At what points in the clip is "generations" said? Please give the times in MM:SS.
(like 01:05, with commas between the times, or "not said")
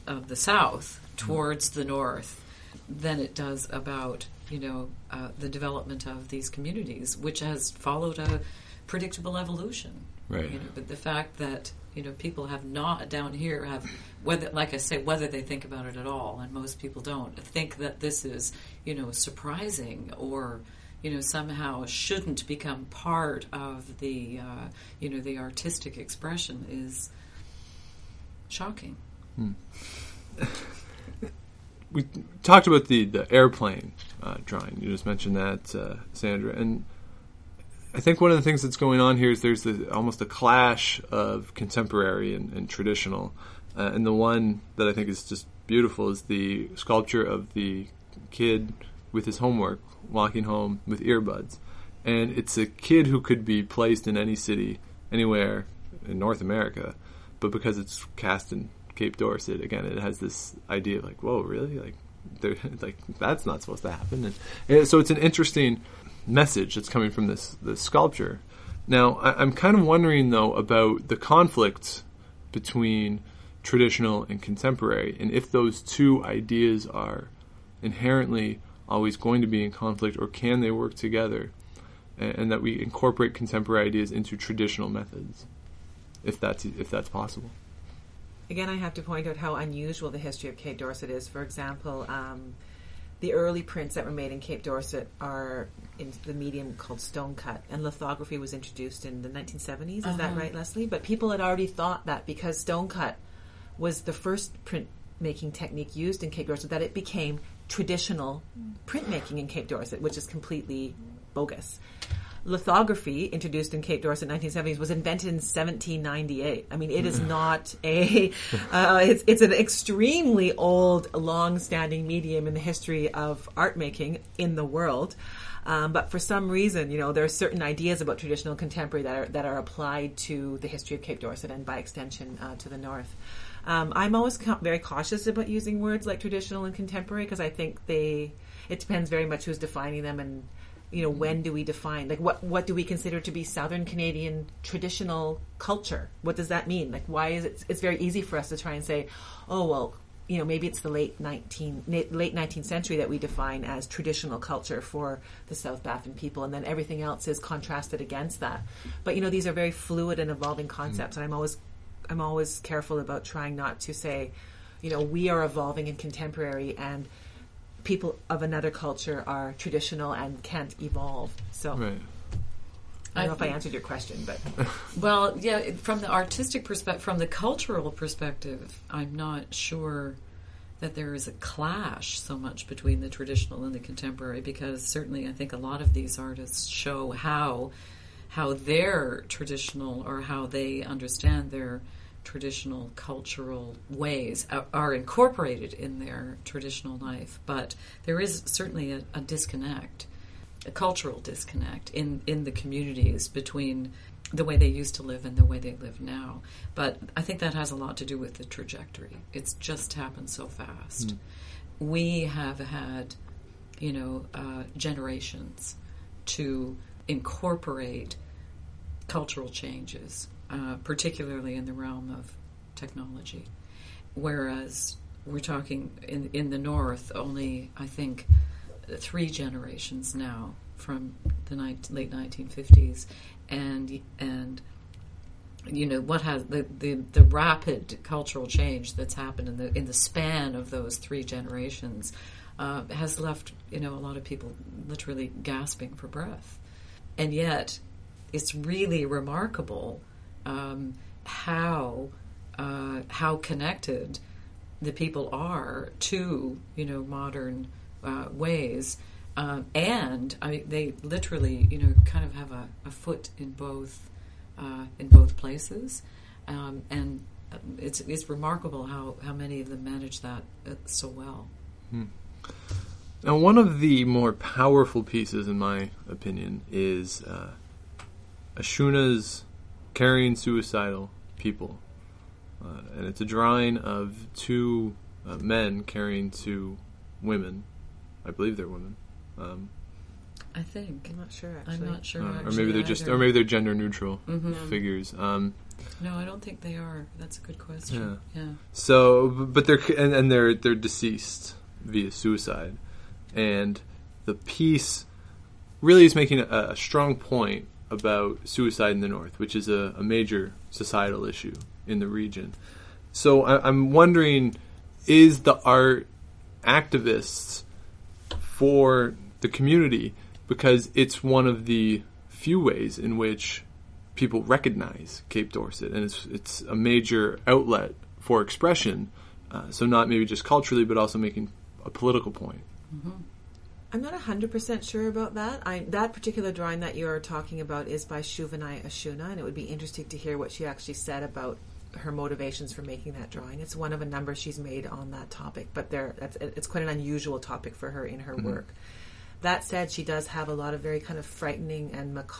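03:34, 03:49, 04:01.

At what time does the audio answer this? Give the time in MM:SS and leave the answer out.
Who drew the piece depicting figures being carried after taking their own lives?
05:38.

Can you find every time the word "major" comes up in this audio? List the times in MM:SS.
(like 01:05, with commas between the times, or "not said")
05:10, 05:26.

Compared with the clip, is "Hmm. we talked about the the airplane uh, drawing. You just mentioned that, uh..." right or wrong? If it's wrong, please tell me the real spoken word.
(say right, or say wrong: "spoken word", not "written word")
right.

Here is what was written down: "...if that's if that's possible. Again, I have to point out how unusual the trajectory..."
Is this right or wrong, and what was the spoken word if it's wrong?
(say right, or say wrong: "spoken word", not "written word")
wrong: "history", not "trajectory".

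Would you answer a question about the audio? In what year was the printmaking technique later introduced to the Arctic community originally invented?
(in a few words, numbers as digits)
1798.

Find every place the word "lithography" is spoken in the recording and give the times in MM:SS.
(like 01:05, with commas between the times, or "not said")
01:37, 01:52.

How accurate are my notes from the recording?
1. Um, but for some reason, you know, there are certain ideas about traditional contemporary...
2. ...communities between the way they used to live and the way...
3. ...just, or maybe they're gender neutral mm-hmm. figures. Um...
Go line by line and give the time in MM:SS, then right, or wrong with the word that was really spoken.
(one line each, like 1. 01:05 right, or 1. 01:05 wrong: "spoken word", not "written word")
1. 02:05 right
2. 03:22 right
3. 04:52 right.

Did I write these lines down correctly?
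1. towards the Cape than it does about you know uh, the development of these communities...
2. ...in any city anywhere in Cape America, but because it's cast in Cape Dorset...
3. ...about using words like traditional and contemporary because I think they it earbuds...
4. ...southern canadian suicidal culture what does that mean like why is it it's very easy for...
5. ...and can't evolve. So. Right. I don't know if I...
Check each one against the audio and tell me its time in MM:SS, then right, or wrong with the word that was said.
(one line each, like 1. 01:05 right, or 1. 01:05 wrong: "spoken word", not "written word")
1. 00:01 wrong: "North", not "Cape"
2. 00:54 wrong: "North", not "Cape"
3. 02:15 wrong: "depends", not "earbuds"
4. 02:23 wrong: "traditional", not "suicidal"
5. 02:50 right.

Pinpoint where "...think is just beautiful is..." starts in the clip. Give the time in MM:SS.
00:44.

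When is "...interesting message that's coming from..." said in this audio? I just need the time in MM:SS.
01:05.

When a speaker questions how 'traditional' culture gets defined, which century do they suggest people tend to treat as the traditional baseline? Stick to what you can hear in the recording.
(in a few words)
late 19th century.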